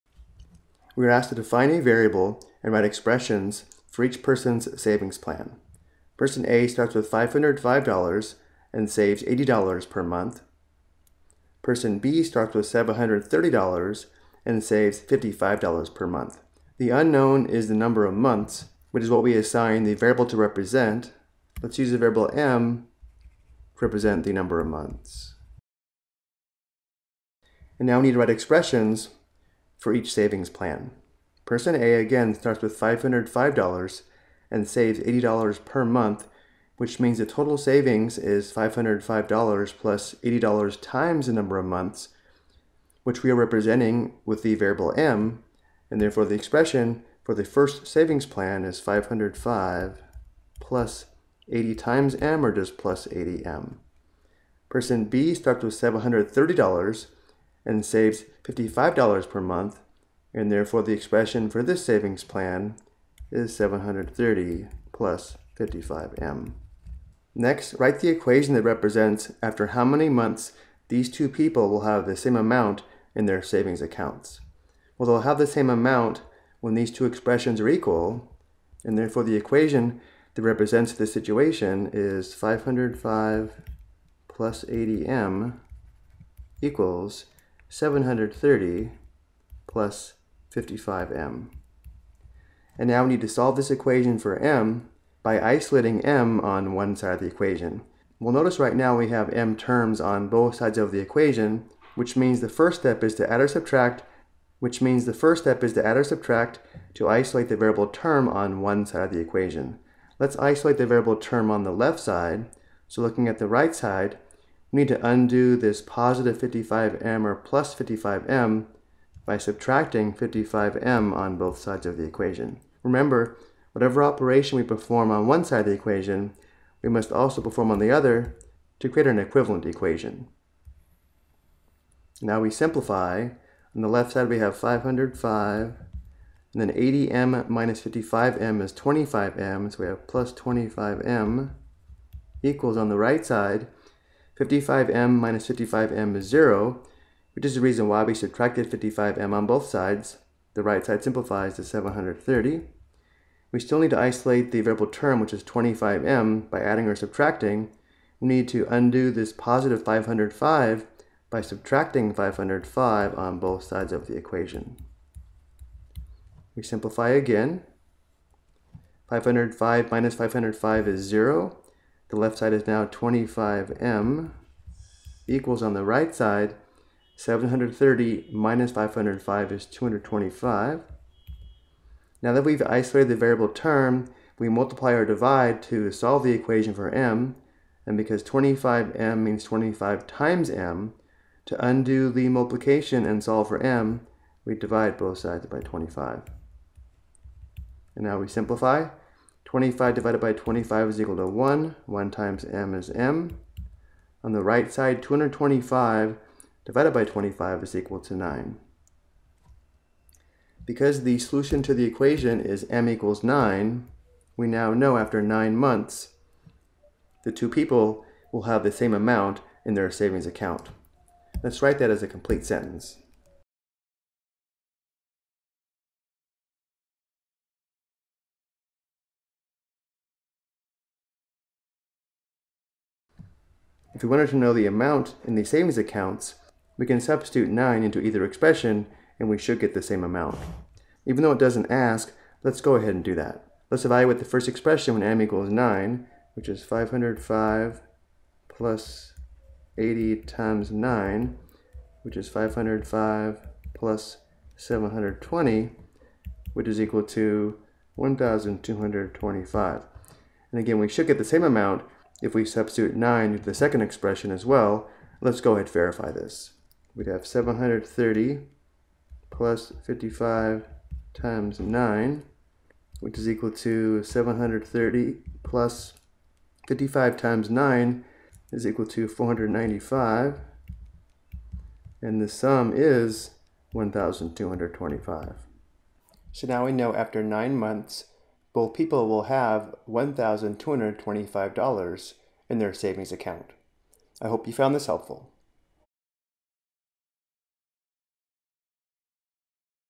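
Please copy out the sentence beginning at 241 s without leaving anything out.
Even though it doesn't ask, let's go ahead and do that.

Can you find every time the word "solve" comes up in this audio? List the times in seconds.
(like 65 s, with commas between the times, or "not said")
93 s, 185 s, 193 s.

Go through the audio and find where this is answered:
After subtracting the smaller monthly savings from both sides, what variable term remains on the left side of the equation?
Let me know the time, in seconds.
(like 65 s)
140 s.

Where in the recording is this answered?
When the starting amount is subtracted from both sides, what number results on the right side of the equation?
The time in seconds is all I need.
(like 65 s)
177 s.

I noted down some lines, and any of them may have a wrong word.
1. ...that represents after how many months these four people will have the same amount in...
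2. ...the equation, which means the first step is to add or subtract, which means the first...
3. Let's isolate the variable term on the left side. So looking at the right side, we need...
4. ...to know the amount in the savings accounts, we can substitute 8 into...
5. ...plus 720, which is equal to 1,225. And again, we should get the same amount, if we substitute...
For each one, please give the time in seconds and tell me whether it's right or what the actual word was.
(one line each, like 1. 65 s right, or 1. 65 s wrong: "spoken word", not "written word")
1. 68 s wrong: "two", not "four"
2. 100 s right
3. 110 s right
4. 234 s wrong: "9", not "8"
5. 253 s right.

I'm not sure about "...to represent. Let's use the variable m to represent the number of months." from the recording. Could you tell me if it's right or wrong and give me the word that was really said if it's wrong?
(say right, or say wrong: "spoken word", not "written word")
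right.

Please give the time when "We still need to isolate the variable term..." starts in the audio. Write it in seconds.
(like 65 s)
153 s.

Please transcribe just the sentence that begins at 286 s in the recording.
So now we know after nine months both people will have $1,225 in their savings account.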